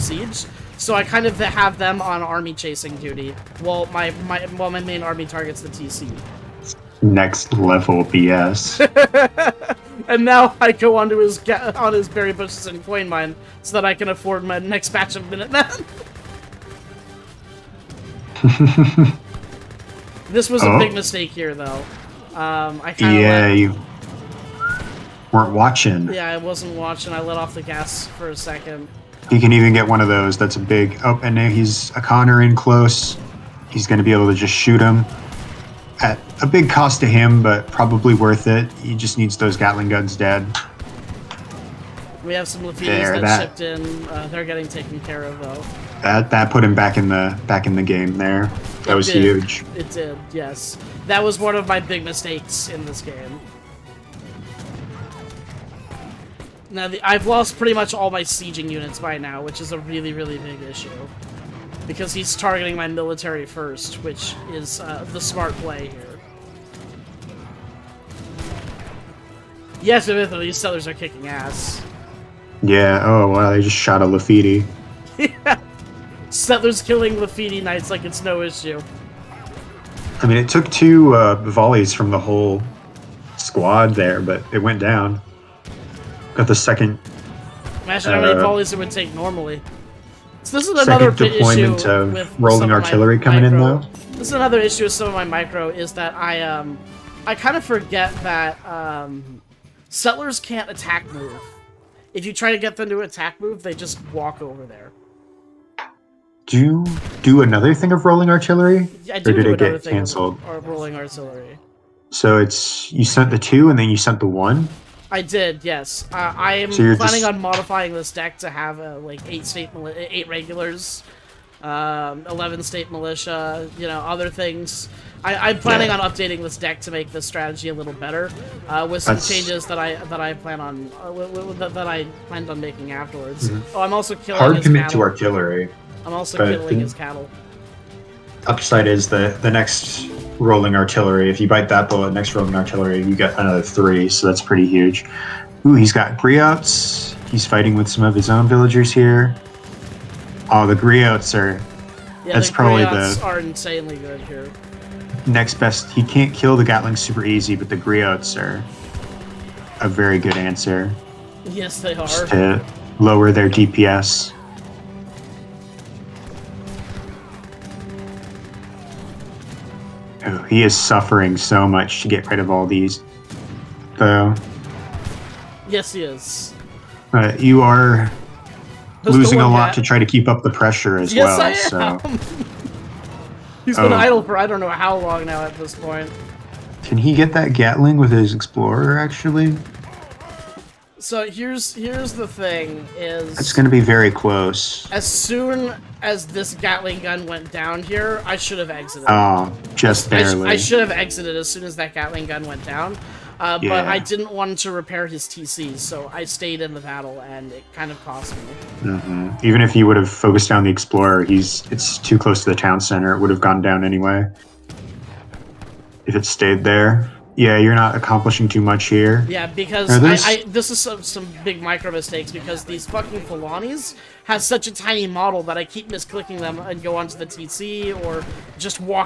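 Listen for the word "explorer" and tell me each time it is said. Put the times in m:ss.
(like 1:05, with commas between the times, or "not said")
3:08, 3:30.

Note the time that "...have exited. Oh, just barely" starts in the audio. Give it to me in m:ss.
3:18.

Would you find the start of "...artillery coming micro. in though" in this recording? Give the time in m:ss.
1:32.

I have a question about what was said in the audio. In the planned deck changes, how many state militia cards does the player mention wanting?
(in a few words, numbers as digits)
11.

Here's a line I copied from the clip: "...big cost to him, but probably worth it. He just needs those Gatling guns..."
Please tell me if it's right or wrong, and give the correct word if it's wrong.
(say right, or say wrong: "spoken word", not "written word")
right.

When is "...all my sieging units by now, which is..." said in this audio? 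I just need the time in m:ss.
0:57.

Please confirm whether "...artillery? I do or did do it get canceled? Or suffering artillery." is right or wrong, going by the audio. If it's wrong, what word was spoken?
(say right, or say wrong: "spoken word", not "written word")
wrong: "rolling", not "suffering".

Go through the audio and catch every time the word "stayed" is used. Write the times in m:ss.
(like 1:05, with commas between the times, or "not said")
3:26, 3:36.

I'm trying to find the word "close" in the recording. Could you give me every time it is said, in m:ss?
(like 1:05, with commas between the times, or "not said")
0:32, 3:14, 3:32.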